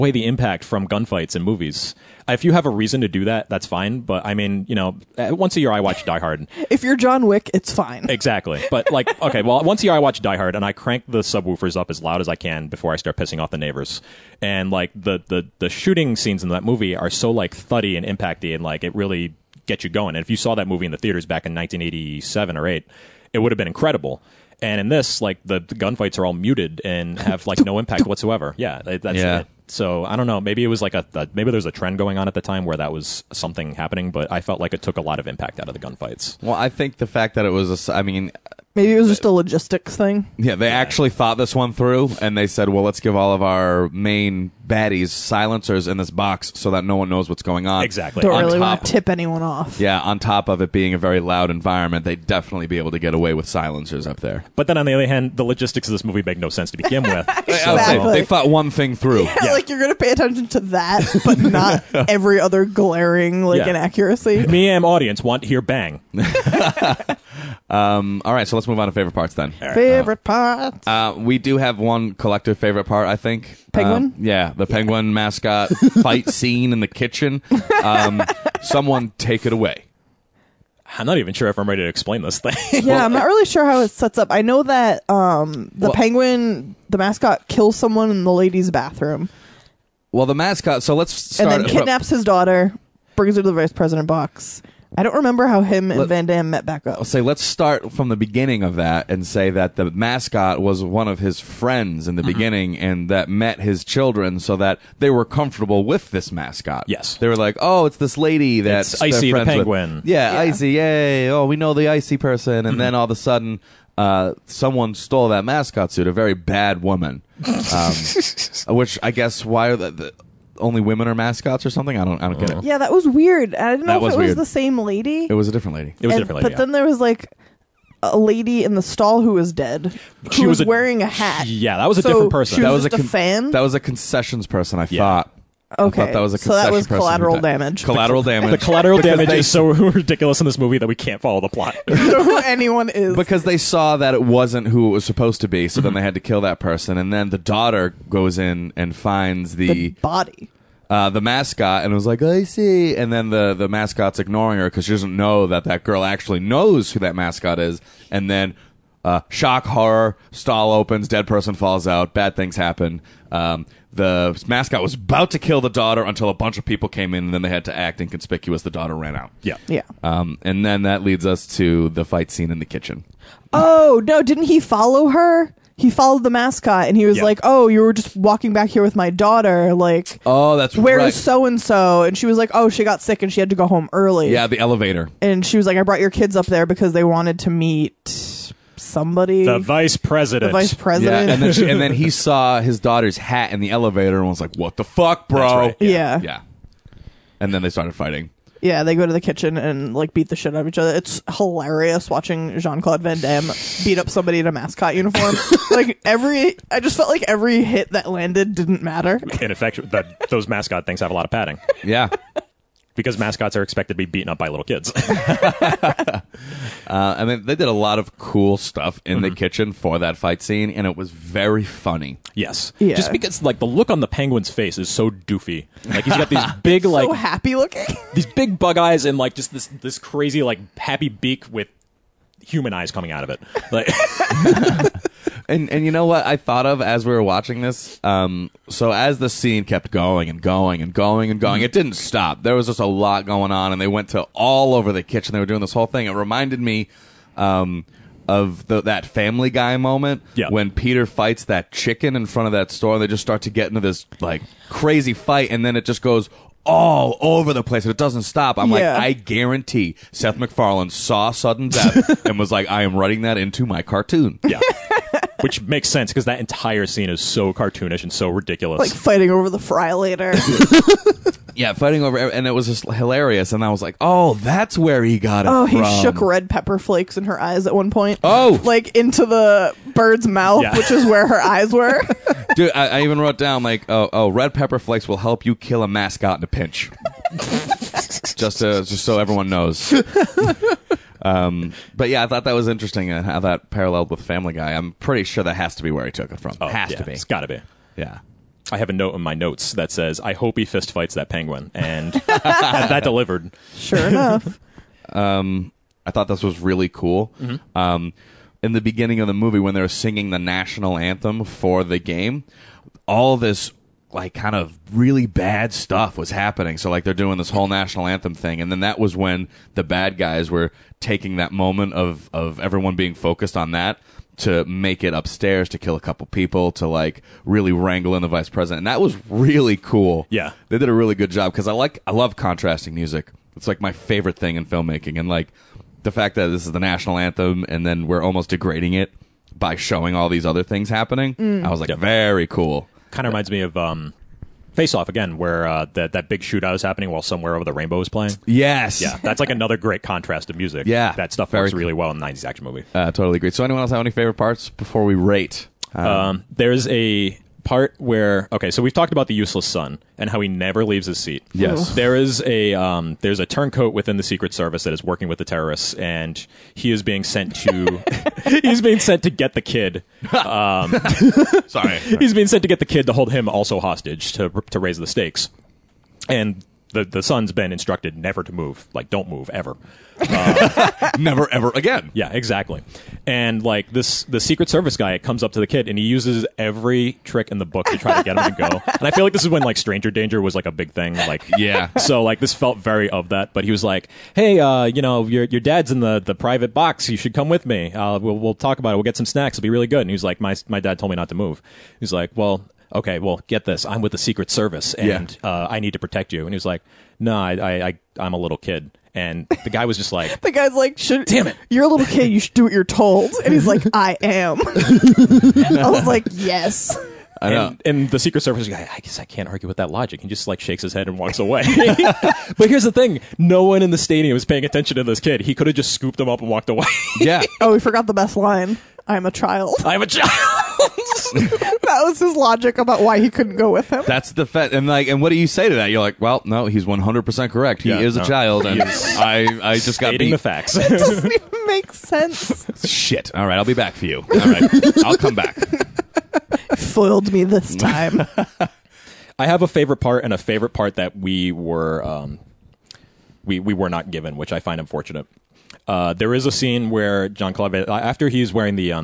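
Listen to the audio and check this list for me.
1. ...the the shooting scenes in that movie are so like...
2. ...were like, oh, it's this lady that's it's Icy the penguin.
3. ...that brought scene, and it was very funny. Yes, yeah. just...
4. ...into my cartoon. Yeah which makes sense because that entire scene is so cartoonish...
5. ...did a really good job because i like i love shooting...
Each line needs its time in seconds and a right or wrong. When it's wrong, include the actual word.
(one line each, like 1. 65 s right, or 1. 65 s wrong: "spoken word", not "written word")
1. 15 s right
2. 107 s right
3. 219 s wrong: "fight", not "brought"
4. 263 s right
5. 330 s wrong: "contrasting", not "shooting".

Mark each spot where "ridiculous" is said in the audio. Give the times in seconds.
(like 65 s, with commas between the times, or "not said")
139 s, 268 s.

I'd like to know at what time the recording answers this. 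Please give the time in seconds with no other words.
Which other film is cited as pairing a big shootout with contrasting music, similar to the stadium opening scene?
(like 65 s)
344 s.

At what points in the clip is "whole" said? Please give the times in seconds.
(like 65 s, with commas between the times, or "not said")
245 s, 317 s.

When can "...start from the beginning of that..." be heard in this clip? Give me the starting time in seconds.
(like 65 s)
97 s.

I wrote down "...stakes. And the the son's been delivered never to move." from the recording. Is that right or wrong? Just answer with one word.
wrong.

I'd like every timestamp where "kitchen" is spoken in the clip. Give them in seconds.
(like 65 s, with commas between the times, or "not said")
76 s, 172 s, 199 s, 219 s, 245 s.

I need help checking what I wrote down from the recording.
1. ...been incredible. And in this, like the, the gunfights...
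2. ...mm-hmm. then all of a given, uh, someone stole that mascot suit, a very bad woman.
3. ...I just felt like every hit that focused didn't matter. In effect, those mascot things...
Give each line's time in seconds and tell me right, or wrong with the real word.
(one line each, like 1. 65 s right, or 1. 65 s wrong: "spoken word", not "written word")
1. 23 s right
2. 112 s wrong: "sudden", not "given"
3. 206 s wrong: "landed", not "focused".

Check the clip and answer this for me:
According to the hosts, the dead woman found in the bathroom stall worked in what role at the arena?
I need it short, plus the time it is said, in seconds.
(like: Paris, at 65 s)
concessions, at 133 s.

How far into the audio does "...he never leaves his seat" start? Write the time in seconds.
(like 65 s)
360 s.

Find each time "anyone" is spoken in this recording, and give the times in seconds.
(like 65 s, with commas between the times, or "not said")
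49 s, 142 s, 353 s.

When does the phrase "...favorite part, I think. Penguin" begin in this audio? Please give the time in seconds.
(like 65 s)
72 s.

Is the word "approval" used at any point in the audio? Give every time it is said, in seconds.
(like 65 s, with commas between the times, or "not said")
not said.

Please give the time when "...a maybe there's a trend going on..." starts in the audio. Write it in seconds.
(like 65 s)
31 s.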